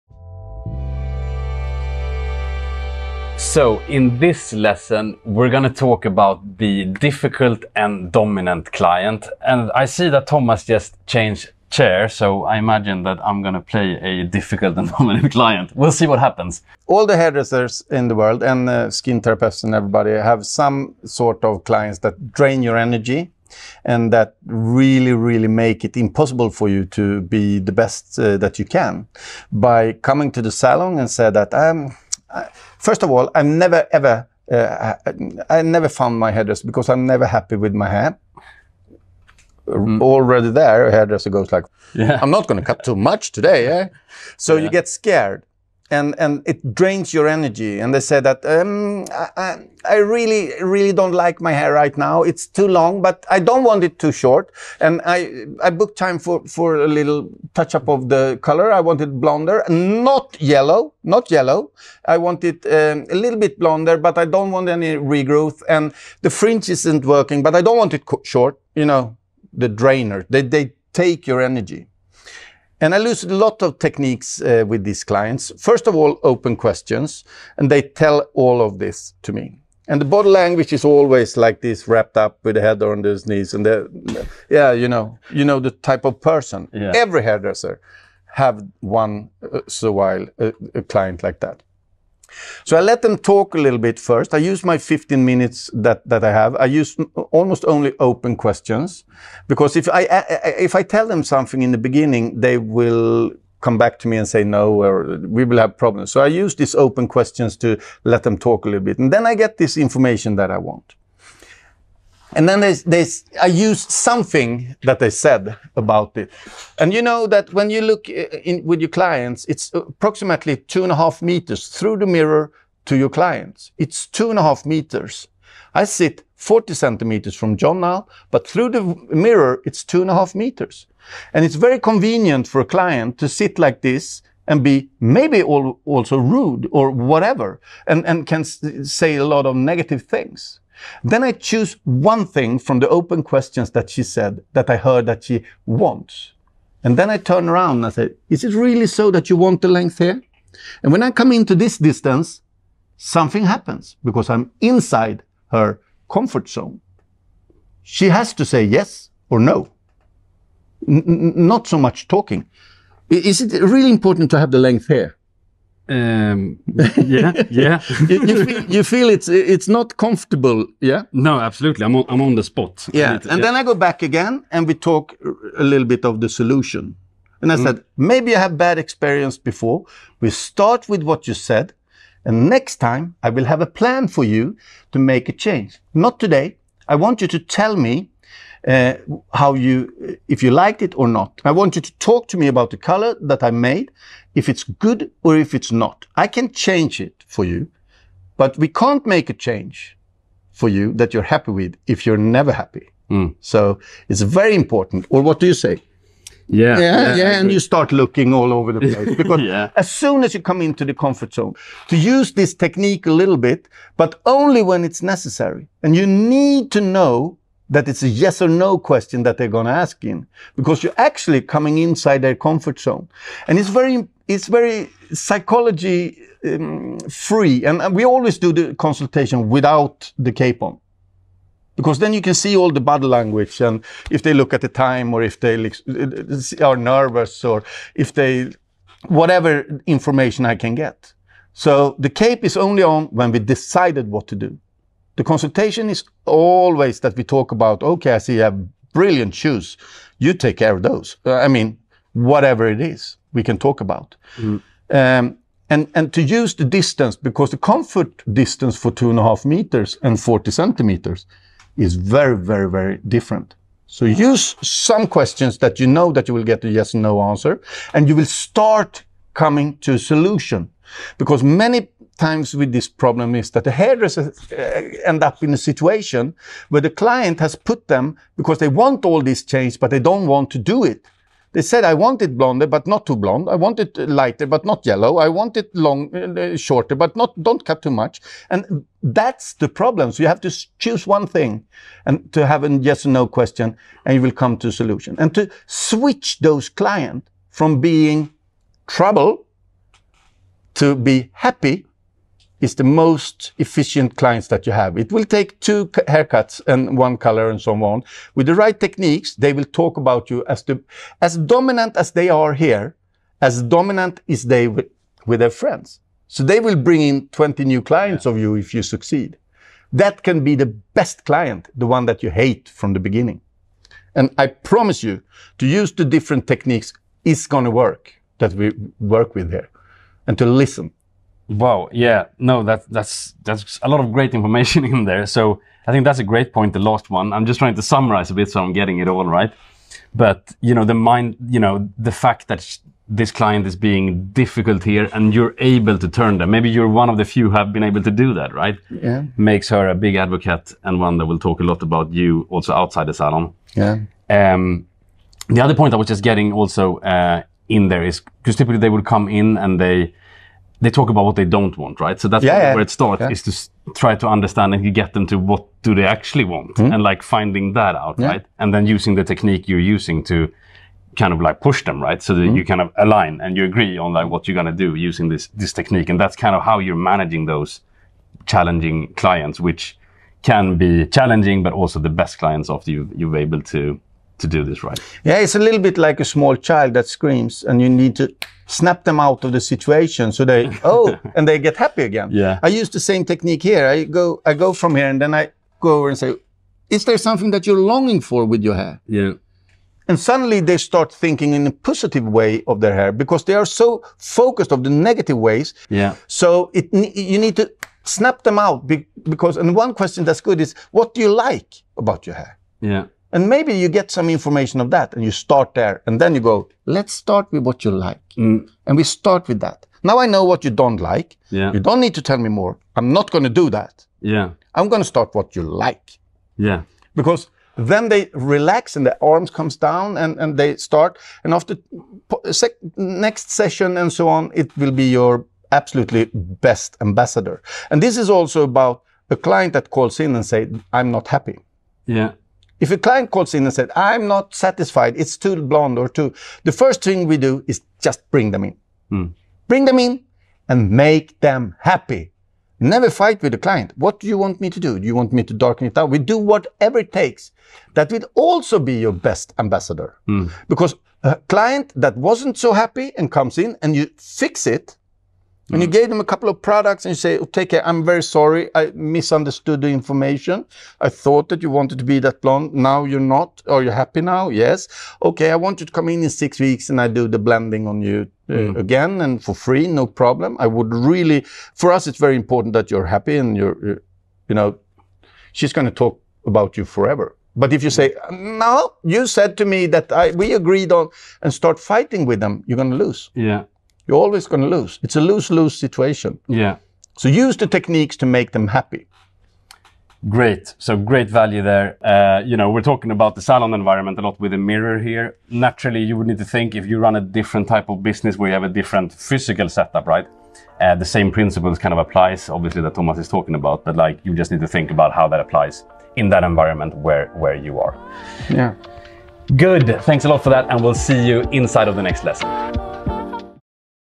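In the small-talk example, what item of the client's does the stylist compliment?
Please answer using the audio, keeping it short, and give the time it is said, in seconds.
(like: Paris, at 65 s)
Shoes, at 249 s.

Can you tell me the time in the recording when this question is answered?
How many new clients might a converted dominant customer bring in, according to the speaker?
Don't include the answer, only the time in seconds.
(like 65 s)
317 s.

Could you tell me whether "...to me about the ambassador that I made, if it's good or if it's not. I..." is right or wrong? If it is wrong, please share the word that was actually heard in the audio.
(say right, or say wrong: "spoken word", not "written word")
wrong: "color", not "ambassador".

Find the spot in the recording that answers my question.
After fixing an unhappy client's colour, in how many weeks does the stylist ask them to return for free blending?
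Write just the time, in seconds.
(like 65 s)
476 s.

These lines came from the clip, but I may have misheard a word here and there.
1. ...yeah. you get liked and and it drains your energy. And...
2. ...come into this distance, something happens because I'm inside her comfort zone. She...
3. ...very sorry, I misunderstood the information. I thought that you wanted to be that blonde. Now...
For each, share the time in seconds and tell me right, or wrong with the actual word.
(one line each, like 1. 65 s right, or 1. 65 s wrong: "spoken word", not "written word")
1. 44 s wrong: "scared", not "liked"
2. 151 s right
3. 468 s right.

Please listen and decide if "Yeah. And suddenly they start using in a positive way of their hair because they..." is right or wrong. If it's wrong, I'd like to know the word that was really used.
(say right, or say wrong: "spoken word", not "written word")
wrong: "thinking", not "using".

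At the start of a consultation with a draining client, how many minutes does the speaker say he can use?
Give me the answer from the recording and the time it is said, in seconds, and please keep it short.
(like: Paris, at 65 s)
15, at 94 s.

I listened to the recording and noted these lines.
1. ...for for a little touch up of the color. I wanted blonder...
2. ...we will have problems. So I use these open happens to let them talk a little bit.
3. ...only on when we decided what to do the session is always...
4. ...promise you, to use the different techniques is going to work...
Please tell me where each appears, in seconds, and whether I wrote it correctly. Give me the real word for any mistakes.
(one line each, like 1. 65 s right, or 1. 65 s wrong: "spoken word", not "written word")
1. 56 s right
2. 105 s wrong: "questions", not "happens"
3. 242 s wrong: "consultation", not "session"
4. 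324 s right.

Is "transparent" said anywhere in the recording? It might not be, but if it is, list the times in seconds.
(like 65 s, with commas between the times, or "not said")
not said.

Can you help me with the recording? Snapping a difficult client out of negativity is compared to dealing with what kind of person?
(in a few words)
A small child.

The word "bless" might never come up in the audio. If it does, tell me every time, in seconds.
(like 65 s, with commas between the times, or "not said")
not said.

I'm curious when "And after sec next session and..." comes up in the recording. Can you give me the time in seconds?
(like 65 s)
431 s.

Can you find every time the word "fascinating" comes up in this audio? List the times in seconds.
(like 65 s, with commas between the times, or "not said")
not said.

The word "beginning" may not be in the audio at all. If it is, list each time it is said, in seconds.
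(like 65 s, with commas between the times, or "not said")
101 s, 322 s.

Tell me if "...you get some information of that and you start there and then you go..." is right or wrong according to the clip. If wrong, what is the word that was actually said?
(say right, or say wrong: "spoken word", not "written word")
right.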